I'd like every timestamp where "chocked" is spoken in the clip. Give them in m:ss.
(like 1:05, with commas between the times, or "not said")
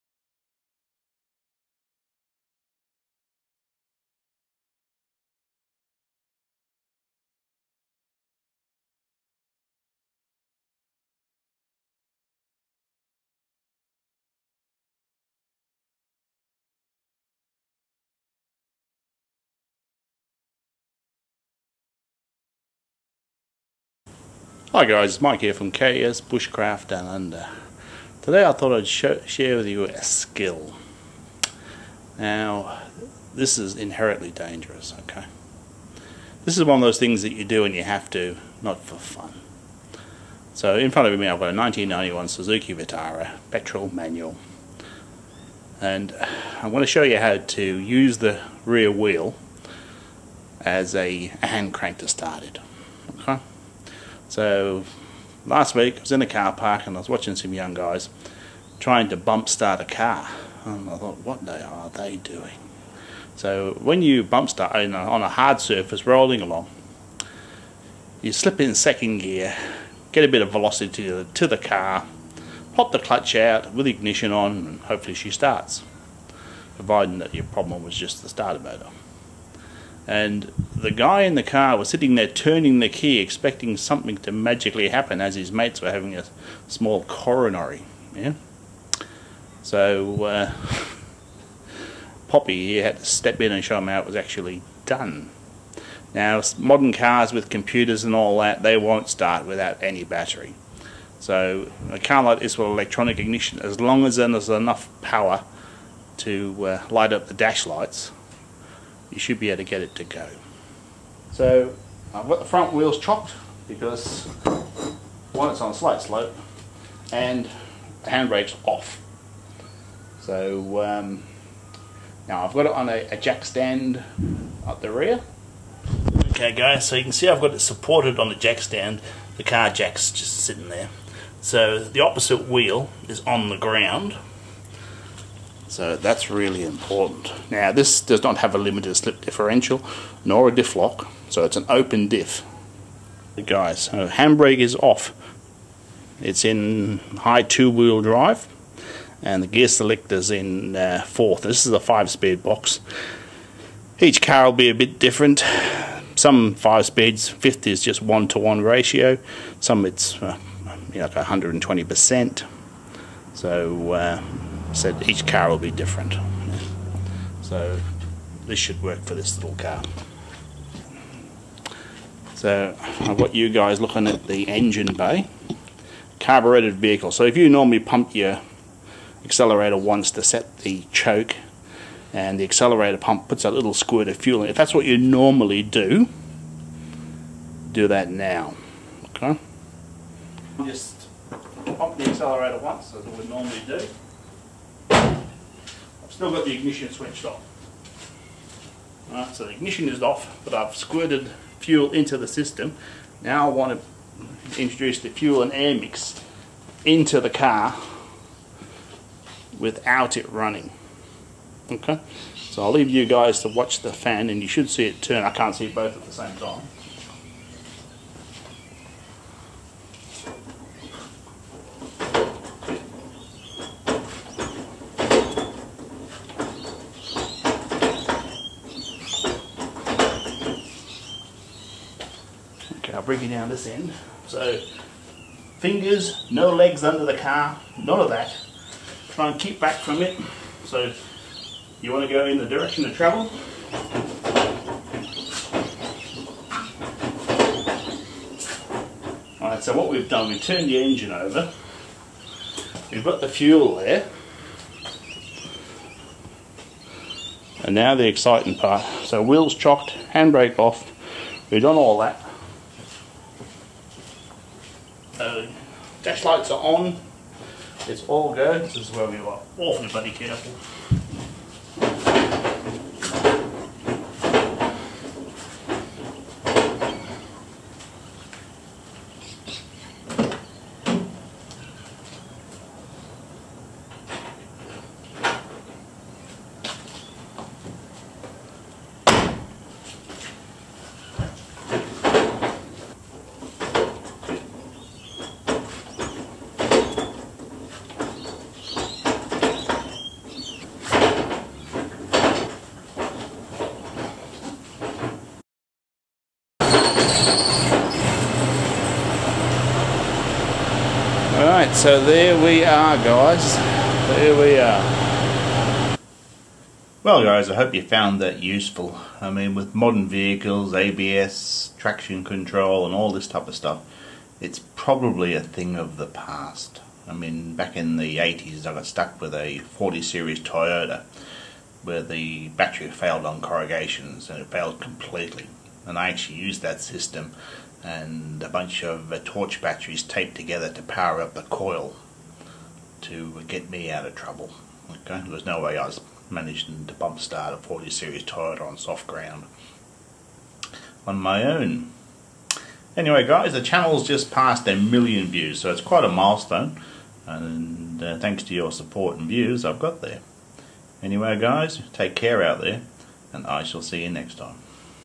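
1:52, 4:19.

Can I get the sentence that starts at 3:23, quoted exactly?
Now I want to introduce the fuel and air mix into the car without it running.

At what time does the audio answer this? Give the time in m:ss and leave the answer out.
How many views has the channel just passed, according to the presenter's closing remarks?
5:54.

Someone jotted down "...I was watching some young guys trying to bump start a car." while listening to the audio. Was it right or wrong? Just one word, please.
right.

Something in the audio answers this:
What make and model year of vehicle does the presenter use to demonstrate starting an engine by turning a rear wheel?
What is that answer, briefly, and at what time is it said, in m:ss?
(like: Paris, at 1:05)
1991 Suzuki Vitara, at 0:41.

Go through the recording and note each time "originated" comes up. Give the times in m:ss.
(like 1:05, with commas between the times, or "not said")
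not said.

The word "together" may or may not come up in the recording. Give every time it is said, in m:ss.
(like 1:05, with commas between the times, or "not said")
5:40.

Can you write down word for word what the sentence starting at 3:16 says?
I've still got the ignition switched off.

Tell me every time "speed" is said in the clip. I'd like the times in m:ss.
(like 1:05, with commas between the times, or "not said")
2:31, 2:36.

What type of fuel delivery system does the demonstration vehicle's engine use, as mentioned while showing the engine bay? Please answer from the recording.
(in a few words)
Carbureted.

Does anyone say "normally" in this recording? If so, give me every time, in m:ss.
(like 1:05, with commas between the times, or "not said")
2:57, 3:04, 3:13.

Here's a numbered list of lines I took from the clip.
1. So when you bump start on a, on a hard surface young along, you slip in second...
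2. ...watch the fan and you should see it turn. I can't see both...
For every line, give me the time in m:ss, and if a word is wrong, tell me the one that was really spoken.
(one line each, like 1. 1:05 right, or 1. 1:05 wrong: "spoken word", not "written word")
1. 1:03 wrong: "rolling", not "young"
2. 3:33 right.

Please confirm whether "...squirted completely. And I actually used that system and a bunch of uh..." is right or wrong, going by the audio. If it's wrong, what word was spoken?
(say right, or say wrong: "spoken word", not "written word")
wrong: "failed", not "squirted".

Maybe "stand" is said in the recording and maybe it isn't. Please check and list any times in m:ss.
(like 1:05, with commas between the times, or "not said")
2:03, 2:08.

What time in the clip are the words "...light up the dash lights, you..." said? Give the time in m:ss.
1:46.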